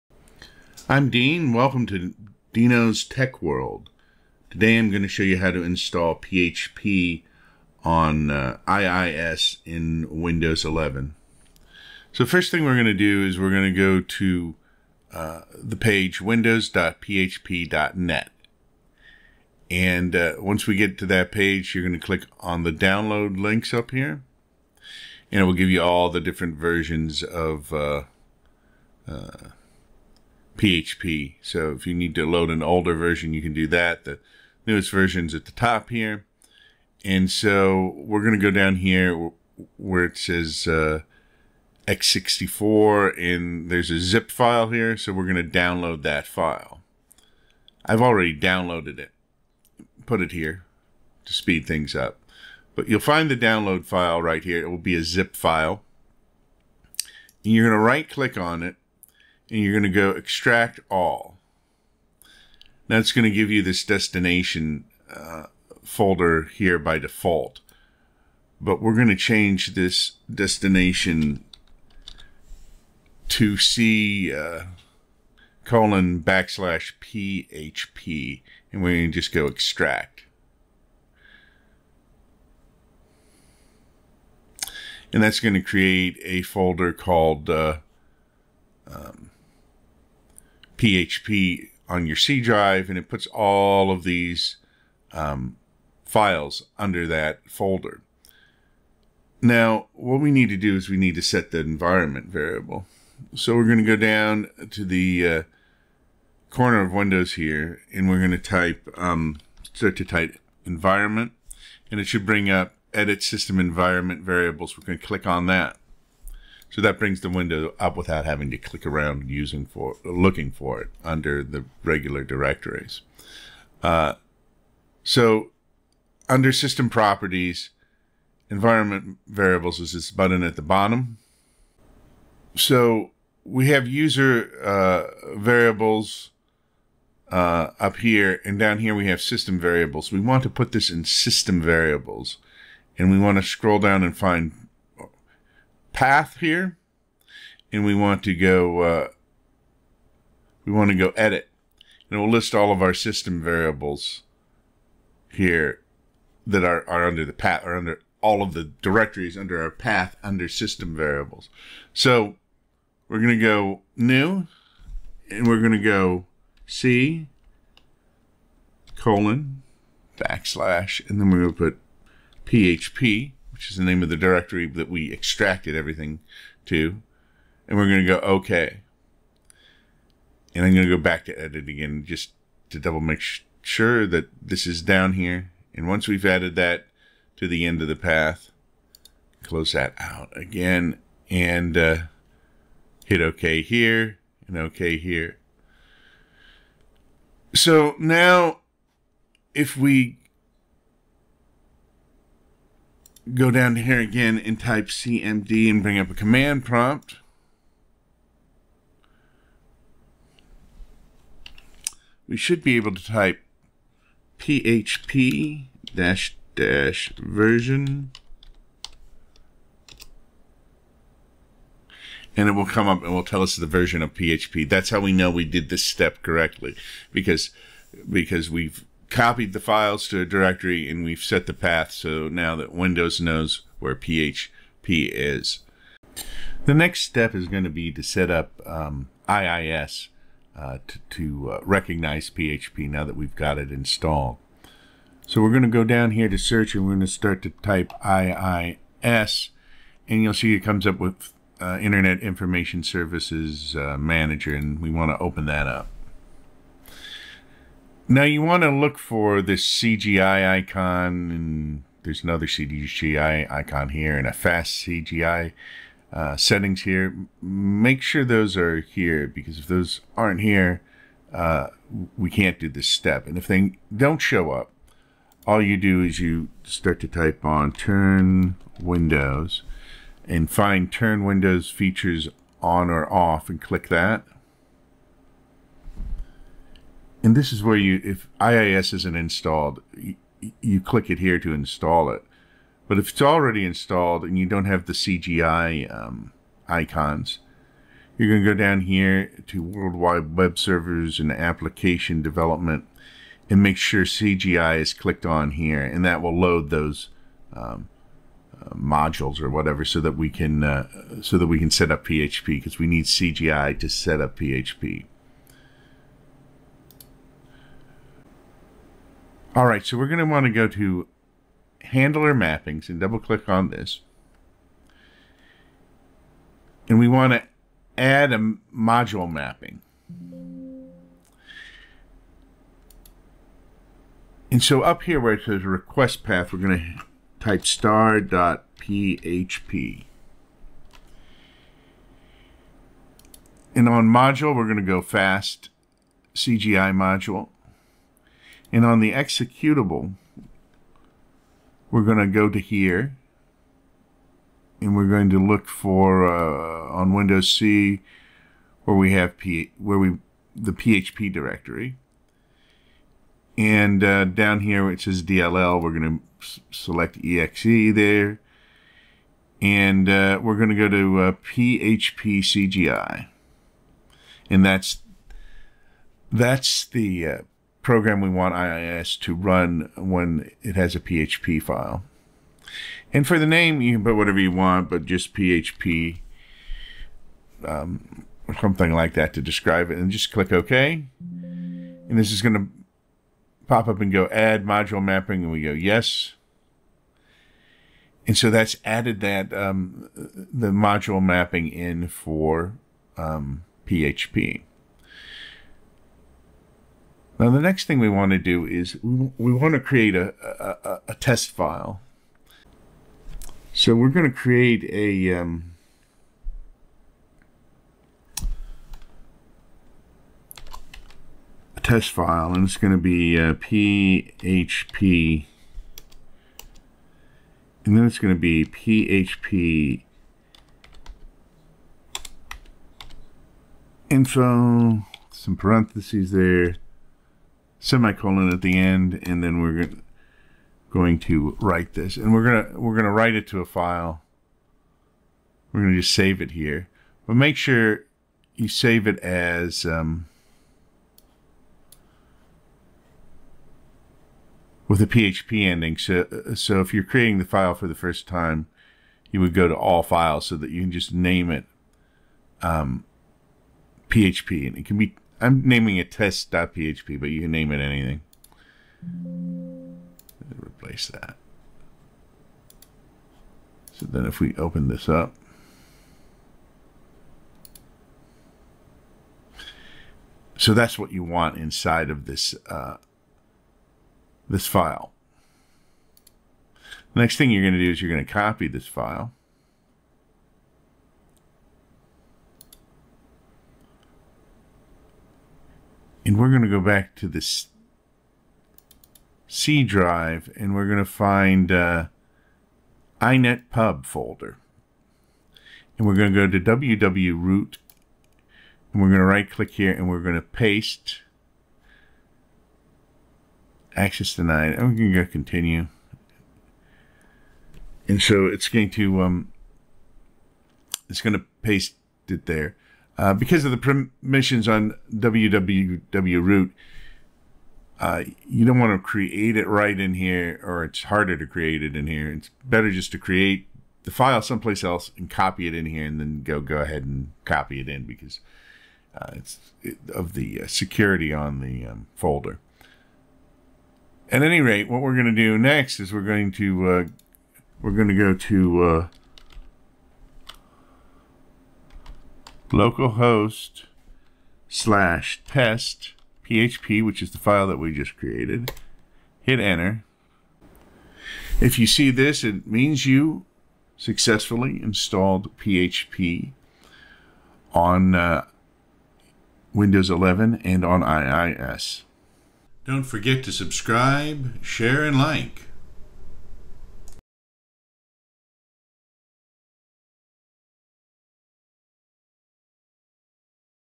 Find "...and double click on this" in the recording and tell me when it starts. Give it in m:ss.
5:22.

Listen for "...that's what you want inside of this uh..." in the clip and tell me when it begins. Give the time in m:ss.
8:00.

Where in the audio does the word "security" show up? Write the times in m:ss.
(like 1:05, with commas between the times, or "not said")
9:00.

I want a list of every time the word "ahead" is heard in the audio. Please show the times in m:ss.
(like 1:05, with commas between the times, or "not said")
8:56.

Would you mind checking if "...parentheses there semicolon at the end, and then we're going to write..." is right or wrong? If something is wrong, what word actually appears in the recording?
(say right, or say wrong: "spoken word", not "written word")
right.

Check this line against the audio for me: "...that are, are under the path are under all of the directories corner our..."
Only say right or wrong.
wrong.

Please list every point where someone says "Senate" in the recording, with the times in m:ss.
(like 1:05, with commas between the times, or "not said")
not said.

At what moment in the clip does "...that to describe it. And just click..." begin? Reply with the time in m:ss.
6:29.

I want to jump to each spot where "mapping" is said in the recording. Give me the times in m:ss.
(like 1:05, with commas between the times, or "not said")
5:22, 5:29, 6:35, 6:41.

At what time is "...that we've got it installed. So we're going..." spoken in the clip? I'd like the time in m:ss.
4:03.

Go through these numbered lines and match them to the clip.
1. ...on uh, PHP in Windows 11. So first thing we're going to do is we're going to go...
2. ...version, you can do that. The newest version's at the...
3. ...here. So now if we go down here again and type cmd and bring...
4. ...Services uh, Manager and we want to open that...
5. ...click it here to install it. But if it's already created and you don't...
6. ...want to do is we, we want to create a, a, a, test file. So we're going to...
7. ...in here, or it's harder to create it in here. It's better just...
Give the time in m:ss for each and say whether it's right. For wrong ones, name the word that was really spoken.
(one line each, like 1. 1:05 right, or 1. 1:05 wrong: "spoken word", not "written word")
1. 0:07 wrong: "IIS", not "PHP"
2. 0:32 right
3. 3:14 right
4. 4:12 right
5. 4:50 wrong: "installed", not "created"
6. 6:48 right
7. 8:49 right.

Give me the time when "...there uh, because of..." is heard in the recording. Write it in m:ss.
8:42.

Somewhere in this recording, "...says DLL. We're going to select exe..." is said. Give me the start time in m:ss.
6:05.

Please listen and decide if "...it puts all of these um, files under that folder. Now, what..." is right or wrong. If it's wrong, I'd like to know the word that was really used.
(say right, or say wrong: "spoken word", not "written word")
right.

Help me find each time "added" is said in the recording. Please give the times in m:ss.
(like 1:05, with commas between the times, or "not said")
3:06, 6:38.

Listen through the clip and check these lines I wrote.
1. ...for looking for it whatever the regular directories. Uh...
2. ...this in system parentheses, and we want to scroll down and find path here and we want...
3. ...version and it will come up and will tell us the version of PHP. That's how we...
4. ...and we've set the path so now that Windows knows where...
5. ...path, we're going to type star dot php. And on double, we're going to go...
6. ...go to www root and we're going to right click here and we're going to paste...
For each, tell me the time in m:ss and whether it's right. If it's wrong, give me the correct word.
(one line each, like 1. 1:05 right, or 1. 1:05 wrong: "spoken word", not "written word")
1. 1:59 wrong: "under", not "whatever"
2. 2:20 wrong: "variables", not "parentheses"
3. 3:37 right
4. 3:50 right
5. 5:36 wrong: "module", not "double"
6. 8:26 right.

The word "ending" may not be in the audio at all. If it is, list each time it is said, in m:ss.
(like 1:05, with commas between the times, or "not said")
7:35.